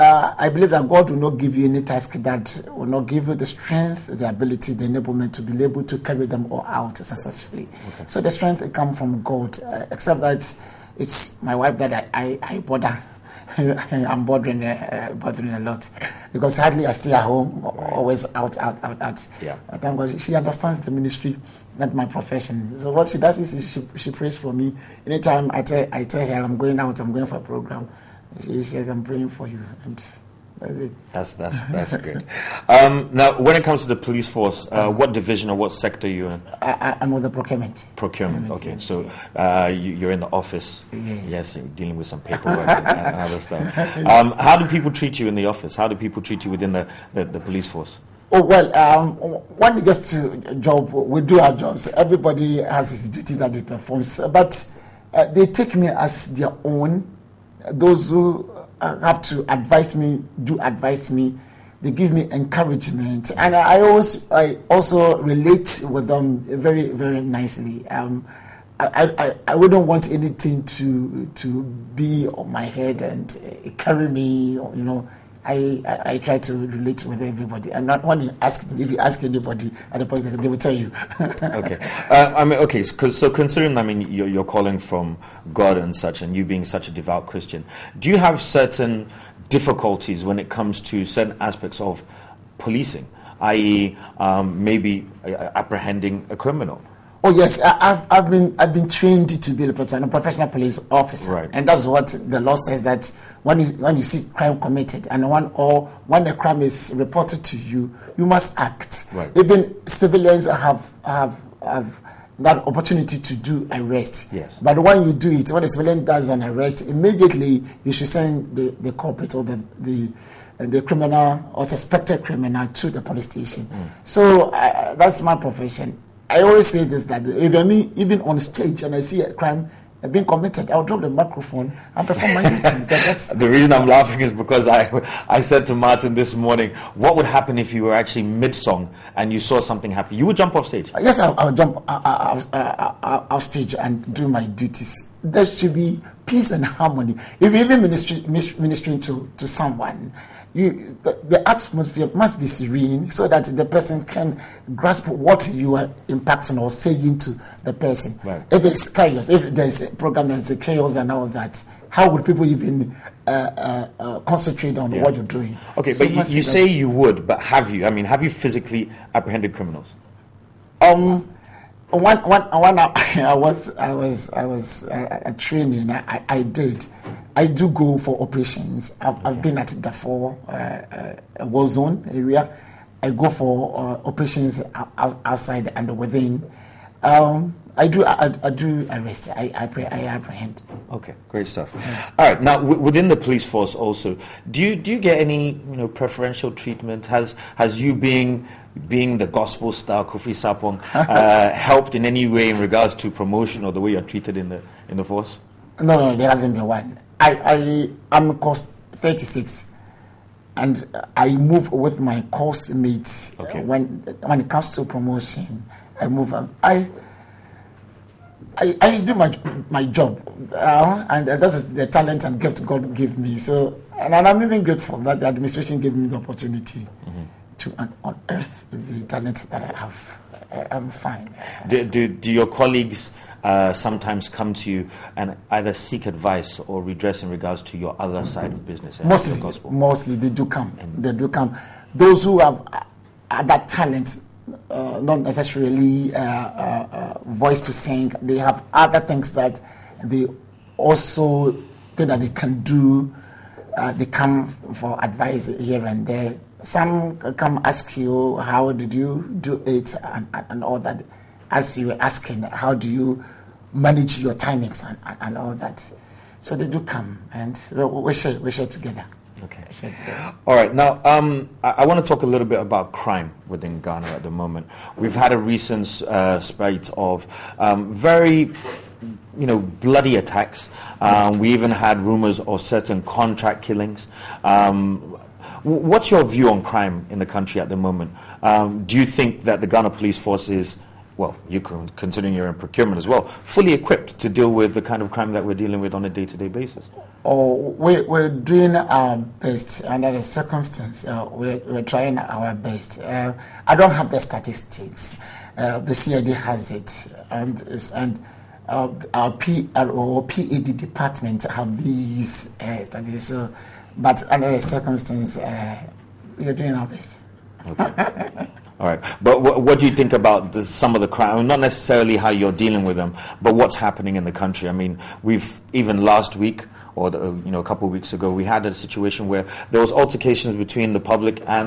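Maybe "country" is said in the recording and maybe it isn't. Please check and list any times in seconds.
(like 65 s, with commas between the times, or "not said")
287 s, 324 s.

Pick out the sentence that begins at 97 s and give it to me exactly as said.
Oh yes, I, have I've been I've been trained to be a professional police officer, right.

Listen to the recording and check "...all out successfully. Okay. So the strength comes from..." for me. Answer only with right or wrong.
right.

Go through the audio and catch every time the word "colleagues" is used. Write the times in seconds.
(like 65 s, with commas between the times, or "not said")
232 s.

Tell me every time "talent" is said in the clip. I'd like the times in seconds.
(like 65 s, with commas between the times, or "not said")
221 s, 229 s, 243 s.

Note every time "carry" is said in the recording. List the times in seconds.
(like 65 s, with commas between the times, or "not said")
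5 s, 73 s.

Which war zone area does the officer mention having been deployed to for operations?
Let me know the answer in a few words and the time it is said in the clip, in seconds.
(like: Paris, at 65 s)
Darfur, at 179 s.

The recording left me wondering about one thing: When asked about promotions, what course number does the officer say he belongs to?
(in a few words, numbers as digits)
36.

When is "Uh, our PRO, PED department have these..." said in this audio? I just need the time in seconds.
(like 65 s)
308 s.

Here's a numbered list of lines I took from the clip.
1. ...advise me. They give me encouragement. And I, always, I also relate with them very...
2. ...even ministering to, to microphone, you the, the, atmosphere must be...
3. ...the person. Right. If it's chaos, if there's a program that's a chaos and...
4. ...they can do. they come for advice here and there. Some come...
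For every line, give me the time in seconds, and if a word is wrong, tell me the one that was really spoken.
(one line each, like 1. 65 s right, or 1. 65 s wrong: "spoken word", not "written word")
1. 60 s right
2. 147 s wrong: "someone", not "microphone"
3. 157 s right
4. 252 s right.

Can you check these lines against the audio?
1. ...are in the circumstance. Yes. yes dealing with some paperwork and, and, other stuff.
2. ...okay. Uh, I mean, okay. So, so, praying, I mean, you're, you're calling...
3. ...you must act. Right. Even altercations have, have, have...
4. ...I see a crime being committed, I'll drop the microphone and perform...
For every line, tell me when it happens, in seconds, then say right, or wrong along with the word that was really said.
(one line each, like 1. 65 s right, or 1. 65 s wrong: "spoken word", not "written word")
1. 40 s wrong: "office", not "circumstance"
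2. 81 s wrong: "considering", not "praying"
3. 108 s wrong: "civilians", not "altercations"
4. 128 s right.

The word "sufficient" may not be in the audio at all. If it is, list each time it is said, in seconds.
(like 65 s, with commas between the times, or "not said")
not said.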